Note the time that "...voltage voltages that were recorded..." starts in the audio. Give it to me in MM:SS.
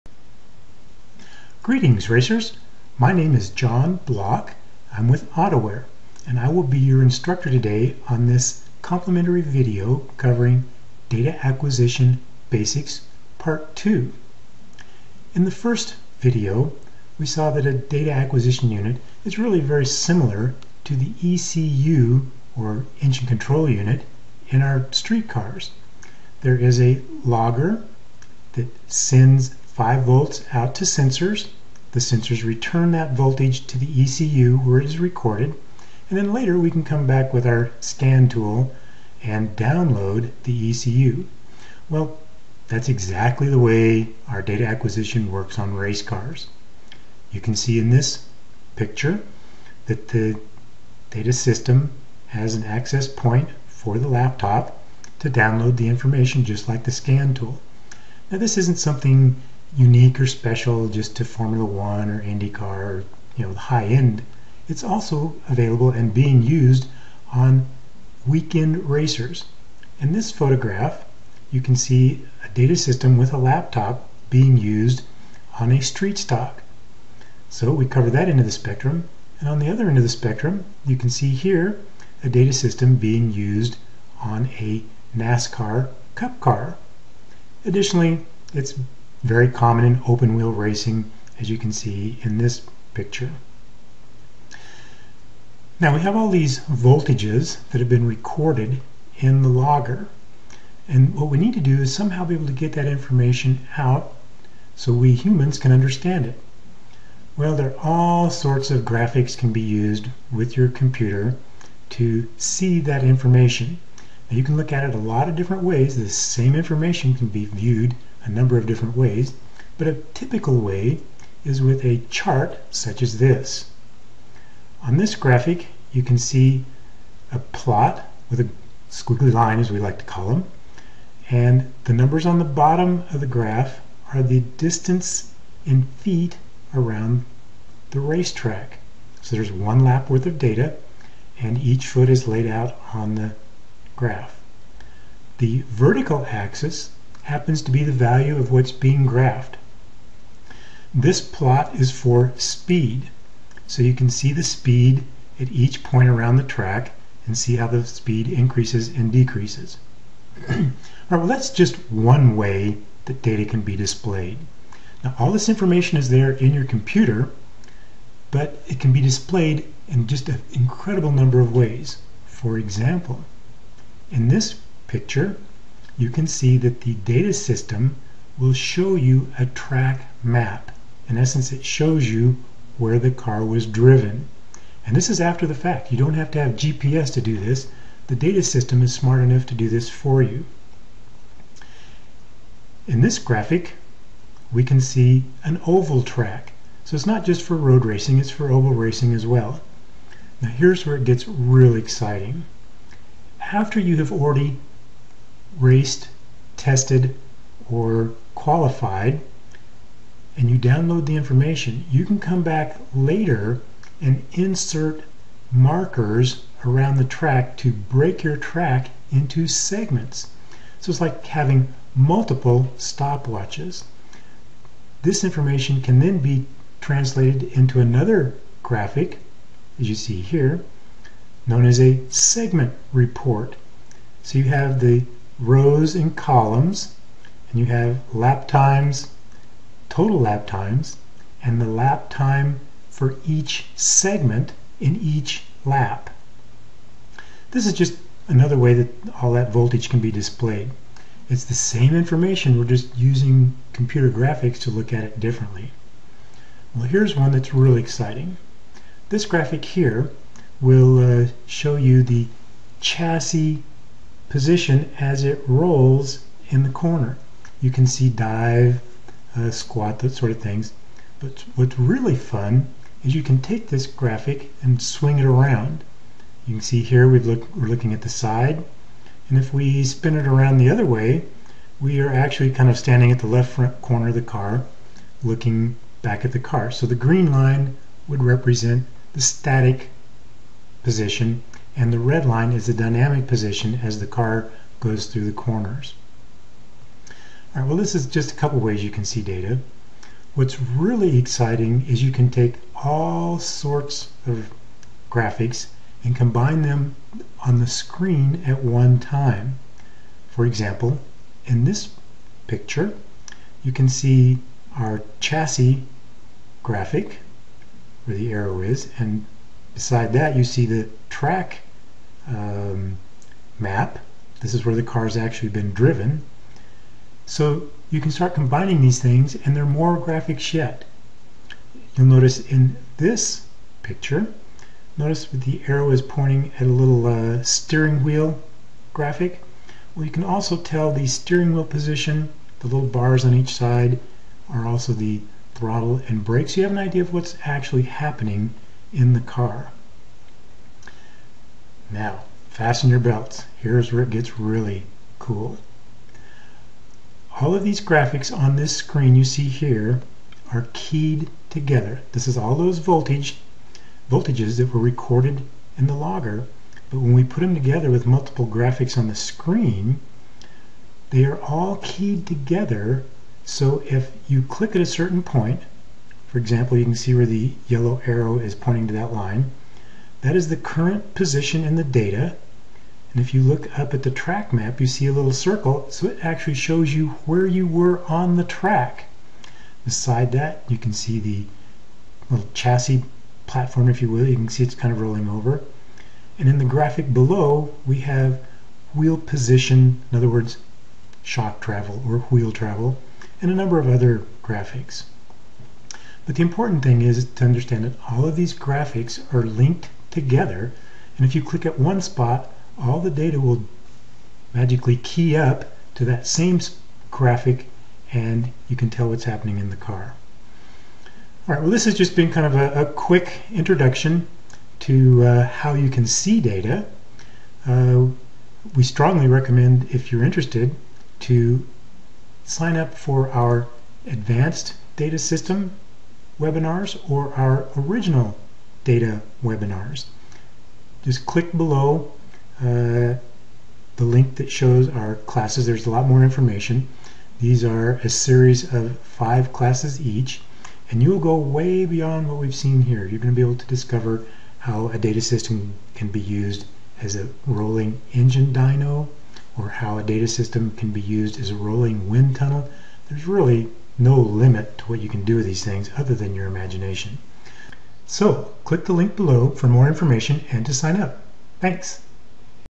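06:02.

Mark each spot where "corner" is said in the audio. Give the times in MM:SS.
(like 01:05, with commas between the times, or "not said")
04:26, 04:43, 04:55.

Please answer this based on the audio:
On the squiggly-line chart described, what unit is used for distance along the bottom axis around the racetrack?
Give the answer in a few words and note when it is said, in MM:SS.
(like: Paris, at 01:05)
feet, at 02:16.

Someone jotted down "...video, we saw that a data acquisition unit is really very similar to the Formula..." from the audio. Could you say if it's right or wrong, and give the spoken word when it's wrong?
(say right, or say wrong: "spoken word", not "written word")
wrong: "ECU", not "Formula".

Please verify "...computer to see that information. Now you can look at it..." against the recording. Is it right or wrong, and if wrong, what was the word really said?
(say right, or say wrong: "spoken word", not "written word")
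right.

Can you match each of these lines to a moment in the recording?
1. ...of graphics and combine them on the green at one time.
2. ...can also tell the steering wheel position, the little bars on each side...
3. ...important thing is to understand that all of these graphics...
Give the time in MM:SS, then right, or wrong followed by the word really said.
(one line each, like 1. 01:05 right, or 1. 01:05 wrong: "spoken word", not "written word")
1. 05:04 wrong: "screen", not "green"
2. 05:40 right
3. 06:46 right.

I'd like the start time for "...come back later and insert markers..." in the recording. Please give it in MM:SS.
03:32.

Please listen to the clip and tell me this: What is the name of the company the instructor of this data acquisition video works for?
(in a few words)
AutoWare.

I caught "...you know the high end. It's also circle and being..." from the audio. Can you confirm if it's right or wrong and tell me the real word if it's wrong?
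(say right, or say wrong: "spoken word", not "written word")
wrong: "available", not "circle".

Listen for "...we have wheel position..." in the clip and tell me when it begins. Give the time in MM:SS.
06:37.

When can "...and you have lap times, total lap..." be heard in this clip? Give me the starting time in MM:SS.
03:57.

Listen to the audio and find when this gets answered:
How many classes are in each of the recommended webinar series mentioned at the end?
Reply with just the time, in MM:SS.
07:29.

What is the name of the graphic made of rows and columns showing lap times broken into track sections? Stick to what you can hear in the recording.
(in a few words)
segment report.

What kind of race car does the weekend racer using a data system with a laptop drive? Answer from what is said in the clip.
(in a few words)
street stock.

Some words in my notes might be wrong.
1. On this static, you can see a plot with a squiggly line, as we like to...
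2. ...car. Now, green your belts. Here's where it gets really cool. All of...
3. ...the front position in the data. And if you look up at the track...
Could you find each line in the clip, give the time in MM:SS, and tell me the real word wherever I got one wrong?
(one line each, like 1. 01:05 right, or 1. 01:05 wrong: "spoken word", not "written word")
1. 02:04 wrong: "graphic", not "static"
2. 05:49 wrong: "fasten", not "green"
3. 06:20 wrong: "current", not "front".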